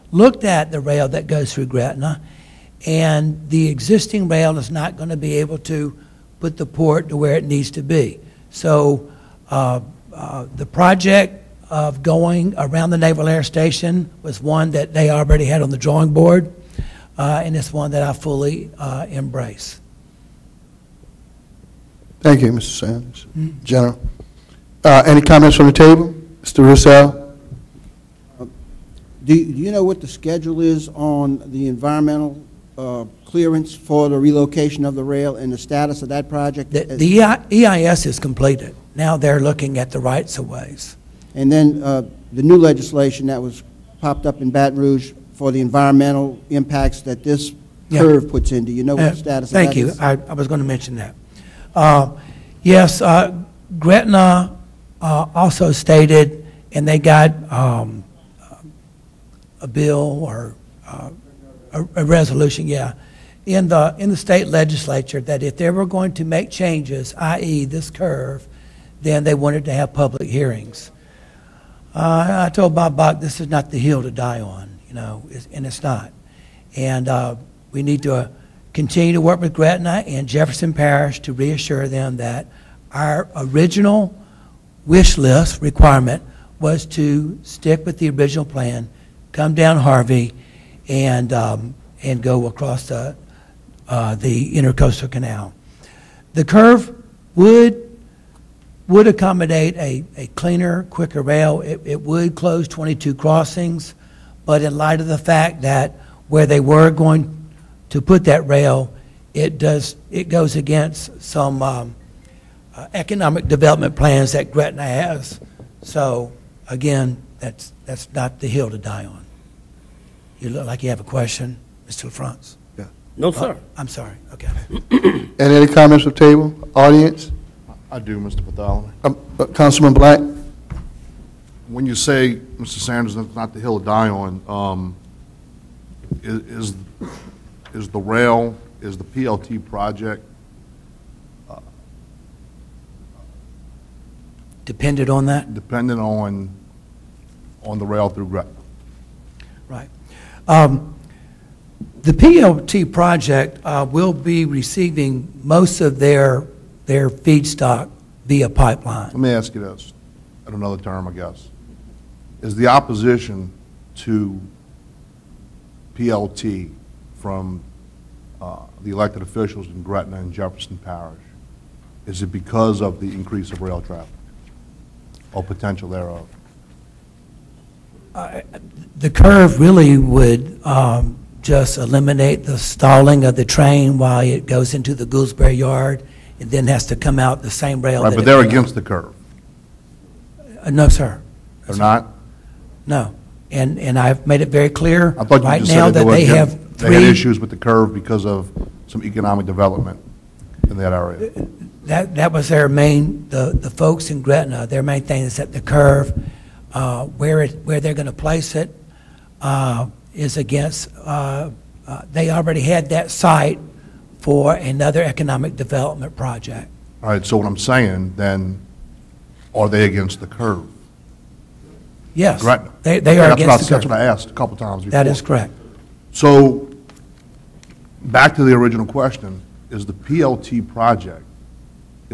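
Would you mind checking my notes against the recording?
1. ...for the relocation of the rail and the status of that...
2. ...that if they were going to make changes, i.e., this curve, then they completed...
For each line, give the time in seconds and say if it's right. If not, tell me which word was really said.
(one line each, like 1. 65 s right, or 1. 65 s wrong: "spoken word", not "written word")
1. 33 s right
2. 65 s wrong: "wanted", not "completed".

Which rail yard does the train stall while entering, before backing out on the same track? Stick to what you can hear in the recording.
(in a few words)
Gouldsboro Yard.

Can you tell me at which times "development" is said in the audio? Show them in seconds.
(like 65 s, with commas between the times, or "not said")
113 s, 199 s, 215 s.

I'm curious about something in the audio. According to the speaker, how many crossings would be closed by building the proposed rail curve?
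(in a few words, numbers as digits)
22.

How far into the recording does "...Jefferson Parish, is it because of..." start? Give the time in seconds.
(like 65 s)
170 s.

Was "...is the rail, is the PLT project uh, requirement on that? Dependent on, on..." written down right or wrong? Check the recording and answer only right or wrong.
wrong.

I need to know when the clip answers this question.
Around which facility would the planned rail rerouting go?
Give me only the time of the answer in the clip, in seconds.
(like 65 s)
12 s.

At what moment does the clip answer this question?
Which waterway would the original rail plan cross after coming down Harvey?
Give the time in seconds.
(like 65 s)
94 s.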